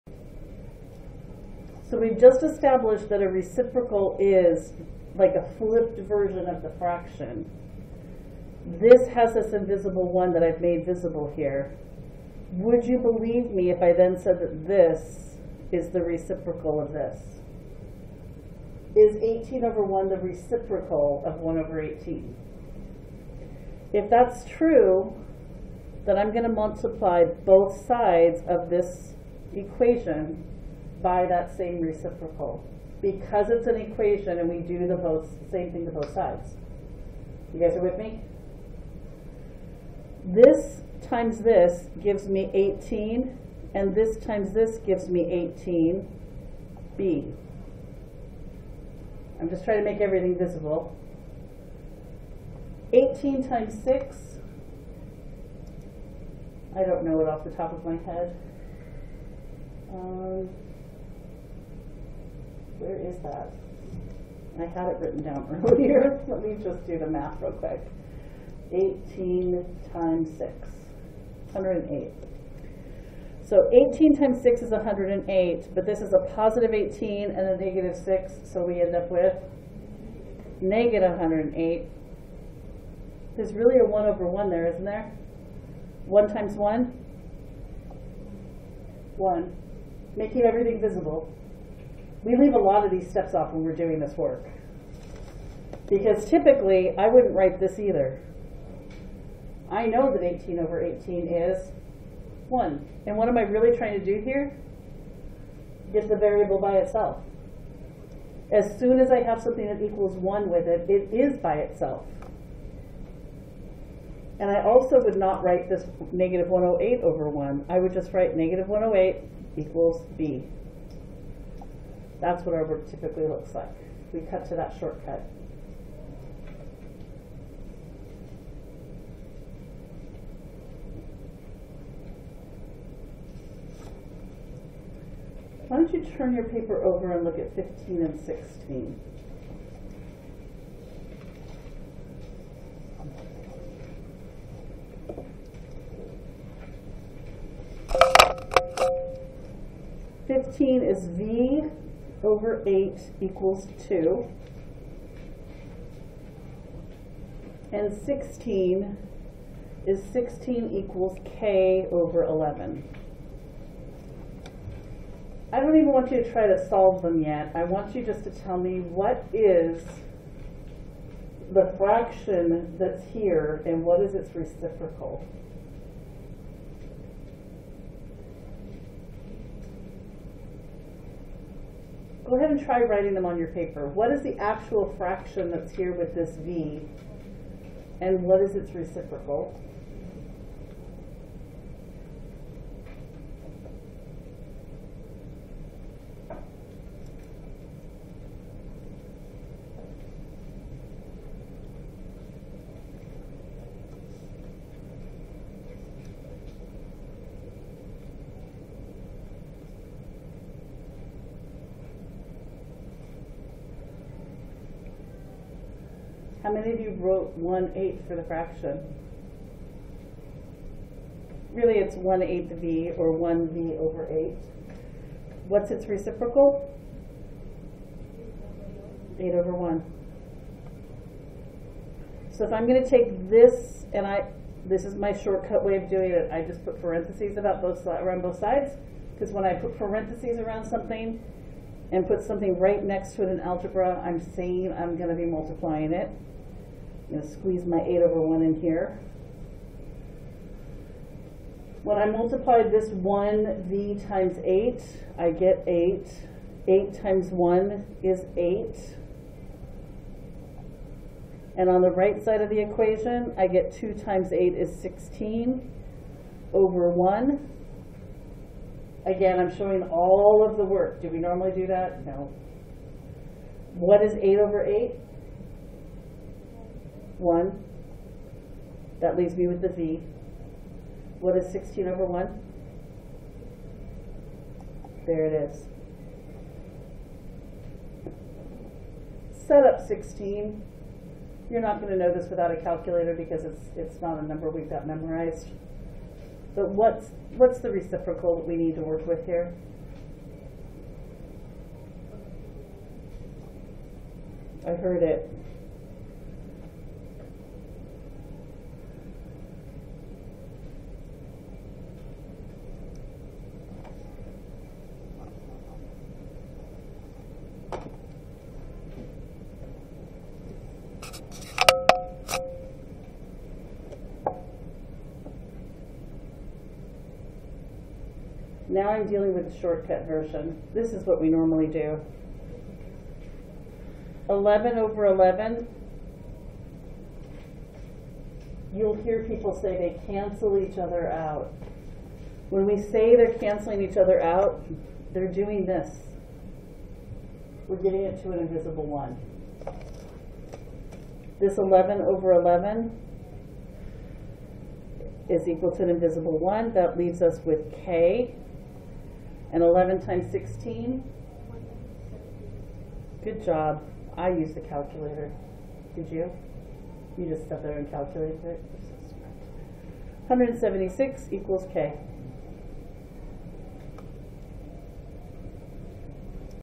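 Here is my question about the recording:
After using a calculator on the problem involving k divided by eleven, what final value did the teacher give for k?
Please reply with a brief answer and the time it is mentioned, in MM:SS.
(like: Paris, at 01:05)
176, at 06:10.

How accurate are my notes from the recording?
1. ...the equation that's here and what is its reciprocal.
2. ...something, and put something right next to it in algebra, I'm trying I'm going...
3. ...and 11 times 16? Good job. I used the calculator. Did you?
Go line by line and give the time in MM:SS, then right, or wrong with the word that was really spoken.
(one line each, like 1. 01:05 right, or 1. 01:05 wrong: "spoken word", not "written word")
1. 02:51 wrong: "fraction", not "equation"
2. 04:00 wrong: "saying", not "trying"
3. 05:59 right.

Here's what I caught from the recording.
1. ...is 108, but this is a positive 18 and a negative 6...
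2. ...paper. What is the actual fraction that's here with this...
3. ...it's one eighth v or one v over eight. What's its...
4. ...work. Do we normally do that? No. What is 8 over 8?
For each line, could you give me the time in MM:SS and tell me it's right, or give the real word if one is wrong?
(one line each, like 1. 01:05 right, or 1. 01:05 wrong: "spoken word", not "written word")
1. 01:14 right
2. 03:03 right
3. 03:41 right
4. 04:30 right.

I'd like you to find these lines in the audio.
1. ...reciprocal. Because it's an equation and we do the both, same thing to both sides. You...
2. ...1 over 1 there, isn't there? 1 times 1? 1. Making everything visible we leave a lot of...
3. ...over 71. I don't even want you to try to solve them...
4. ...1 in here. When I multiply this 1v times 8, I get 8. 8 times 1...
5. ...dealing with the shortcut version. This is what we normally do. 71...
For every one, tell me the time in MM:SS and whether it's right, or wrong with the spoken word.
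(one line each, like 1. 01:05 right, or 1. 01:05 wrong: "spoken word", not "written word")
1. 00:31 right
2. 01:23 right
3. 02:41 wrong: "11", not "71"
4. 04:08 right
5. 05:29 wrong: "11", not "71".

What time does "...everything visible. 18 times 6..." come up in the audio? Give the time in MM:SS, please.
00:49.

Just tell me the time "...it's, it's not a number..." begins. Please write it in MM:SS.
04:53.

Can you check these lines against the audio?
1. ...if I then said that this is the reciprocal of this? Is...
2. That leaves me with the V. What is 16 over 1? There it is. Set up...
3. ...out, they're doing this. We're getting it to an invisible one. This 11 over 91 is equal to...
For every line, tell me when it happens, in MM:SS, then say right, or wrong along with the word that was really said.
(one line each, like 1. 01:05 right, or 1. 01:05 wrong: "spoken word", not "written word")
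1. 00:13 right
2. 04:38 right
3. 05:44 wrong: "11", not "91".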